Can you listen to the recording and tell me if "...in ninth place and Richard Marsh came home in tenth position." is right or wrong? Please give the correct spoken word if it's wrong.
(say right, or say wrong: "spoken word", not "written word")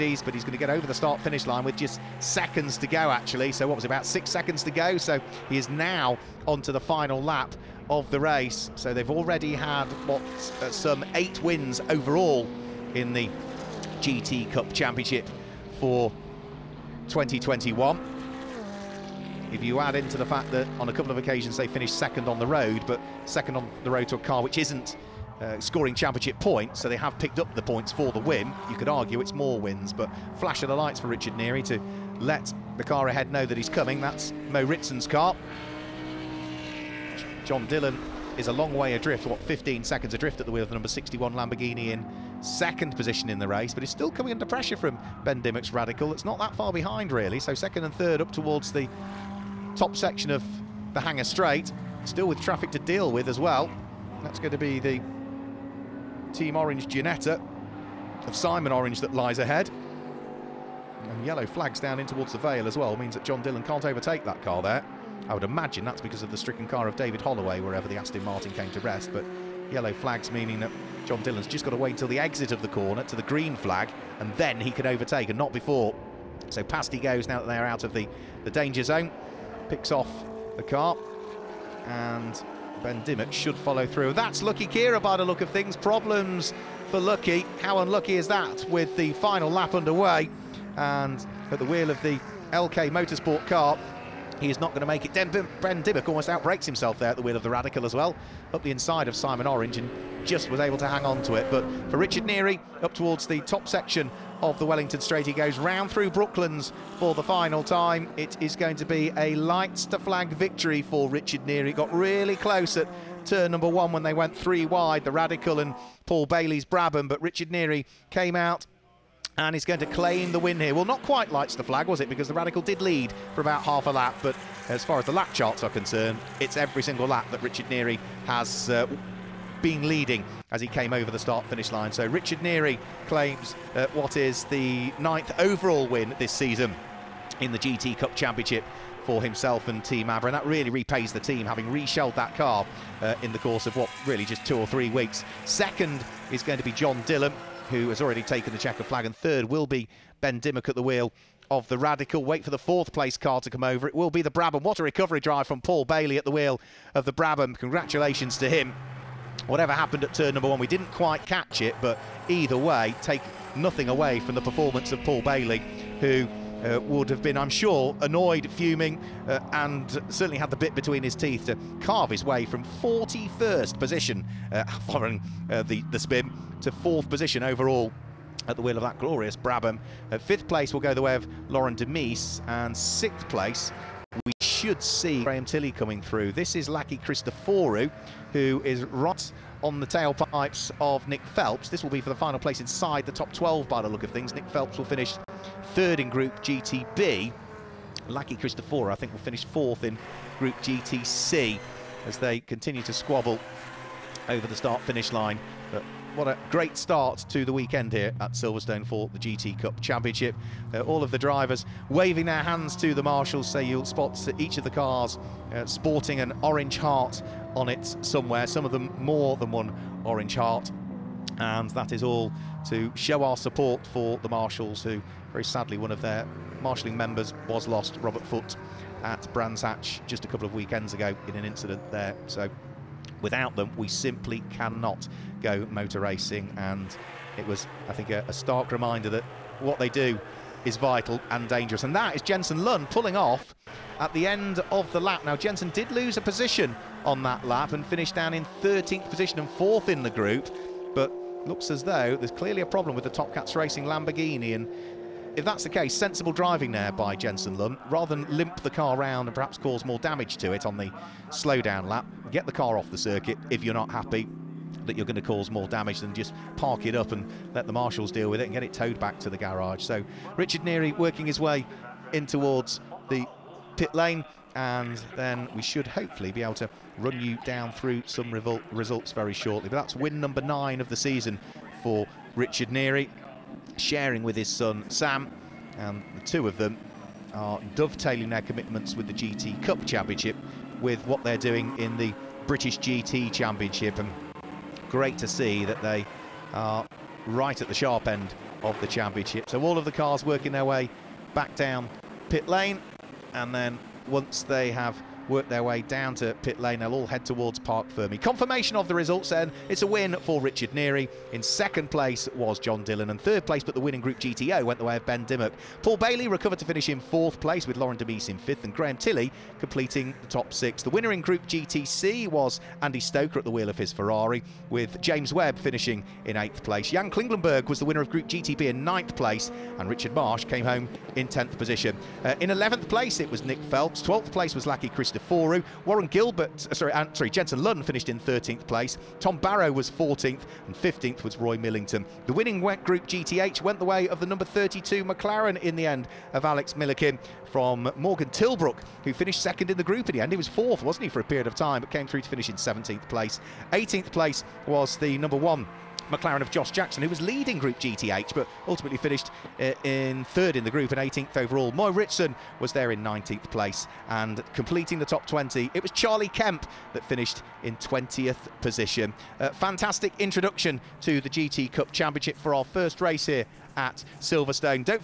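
right.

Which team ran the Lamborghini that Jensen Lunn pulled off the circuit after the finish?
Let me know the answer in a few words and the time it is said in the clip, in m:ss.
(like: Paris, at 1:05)
Top Cats Racing, at 4:13.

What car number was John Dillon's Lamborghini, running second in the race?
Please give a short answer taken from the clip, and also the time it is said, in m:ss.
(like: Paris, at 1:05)
61, at 0:40.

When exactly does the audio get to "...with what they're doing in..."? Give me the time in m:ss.
4:50.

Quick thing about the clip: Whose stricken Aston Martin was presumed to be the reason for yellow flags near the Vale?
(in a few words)
David Holloway.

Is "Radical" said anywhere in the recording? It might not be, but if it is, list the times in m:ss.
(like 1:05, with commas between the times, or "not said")
0:45, 1:37, 1:55, 2:02, 2:31.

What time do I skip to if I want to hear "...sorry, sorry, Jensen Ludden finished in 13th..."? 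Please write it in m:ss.
5:36.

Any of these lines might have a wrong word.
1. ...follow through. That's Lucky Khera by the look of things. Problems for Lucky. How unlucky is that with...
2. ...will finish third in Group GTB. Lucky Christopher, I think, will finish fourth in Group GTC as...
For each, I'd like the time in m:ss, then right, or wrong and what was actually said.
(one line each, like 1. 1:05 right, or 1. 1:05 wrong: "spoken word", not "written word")
1. 1:23 right
2. 3:14 right.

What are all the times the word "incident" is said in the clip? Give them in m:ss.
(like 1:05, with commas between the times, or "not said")
3:51.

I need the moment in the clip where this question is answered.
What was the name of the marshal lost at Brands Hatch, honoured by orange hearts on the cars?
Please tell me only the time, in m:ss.
3:48.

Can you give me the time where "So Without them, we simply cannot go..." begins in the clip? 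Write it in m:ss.
3:52.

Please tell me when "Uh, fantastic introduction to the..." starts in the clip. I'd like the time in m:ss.
6:09.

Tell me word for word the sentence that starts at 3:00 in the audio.
Uh, fifth place will go the way of Laurent de Meeus, and sixth place we should see Graham Tilley coming through.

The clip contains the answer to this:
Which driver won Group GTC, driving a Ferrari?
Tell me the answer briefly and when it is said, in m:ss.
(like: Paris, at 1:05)
Andy Stoker, at 5:22.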